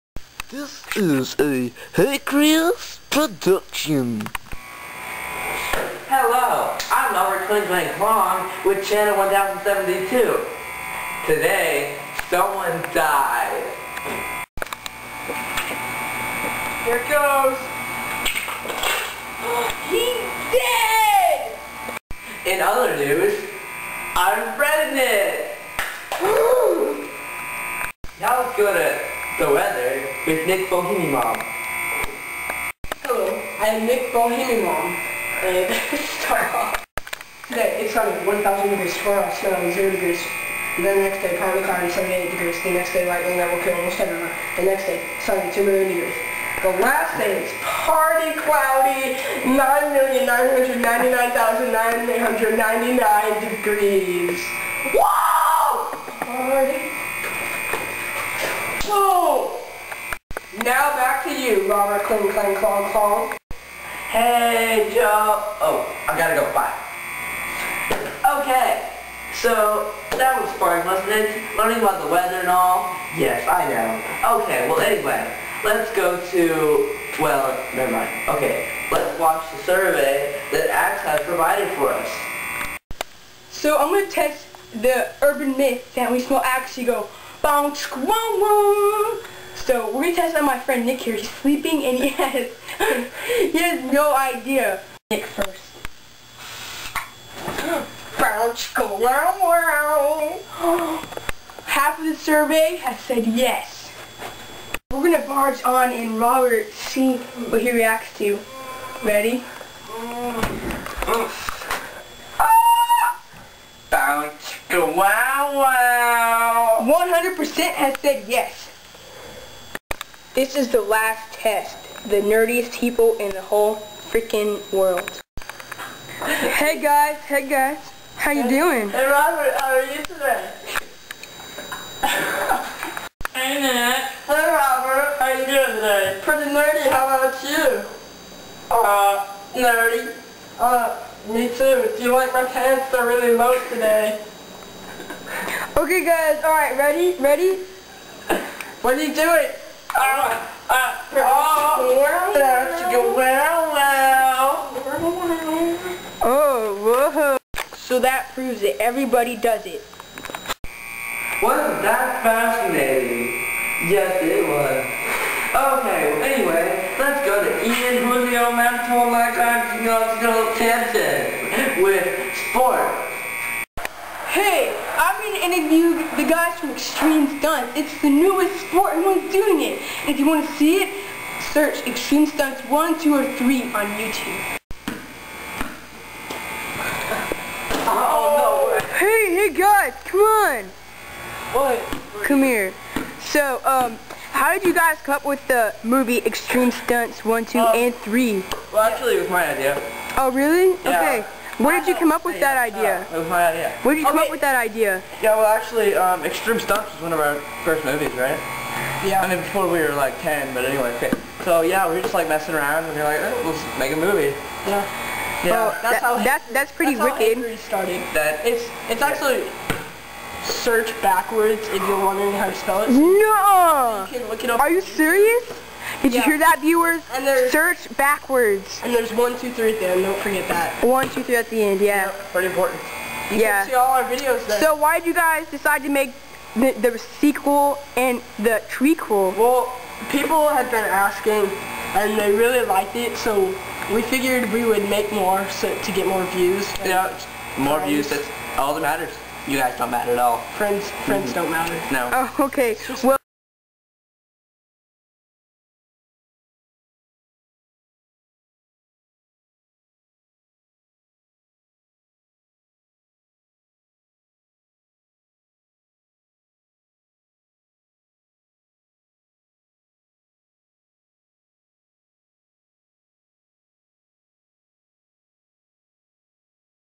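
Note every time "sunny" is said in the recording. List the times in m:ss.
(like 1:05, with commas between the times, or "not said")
0:37, 0:45.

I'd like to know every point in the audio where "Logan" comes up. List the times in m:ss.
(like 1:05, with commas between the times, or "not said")
not said.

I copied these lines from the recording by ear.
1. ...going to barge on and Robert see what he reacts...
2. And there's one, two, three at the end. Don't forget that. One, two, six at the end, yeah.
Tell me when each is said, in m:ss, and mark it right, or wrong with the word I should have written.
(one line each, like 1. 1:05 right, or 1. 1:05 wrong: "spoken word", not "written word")
1. 1:44 right
2. 3:48 wrong: "three", not "six".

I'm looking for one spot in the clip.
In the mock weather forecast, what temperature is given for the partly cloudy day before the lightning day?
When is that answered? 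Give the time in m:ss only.
0:41.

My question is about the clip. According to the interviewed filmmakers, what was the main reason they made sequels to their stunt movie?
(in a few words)
to get more views.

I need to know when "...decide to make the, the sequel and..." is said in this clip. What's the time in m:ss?
3:55.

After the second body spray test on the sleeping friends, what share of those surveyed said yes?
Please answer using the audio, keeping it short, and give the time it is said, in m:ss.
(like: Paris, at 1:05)
100%, at 1:56.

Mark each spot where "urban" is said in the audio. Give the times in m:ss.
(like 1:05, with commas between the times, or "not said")
1:25.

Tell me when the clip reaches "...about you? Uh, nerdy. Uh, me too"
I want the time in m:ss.
2:17.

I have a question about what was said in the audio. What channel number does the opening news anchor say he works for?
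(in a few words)
1072.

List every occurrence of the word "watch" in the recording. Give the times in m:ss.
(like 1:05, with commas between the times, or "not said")
1:19.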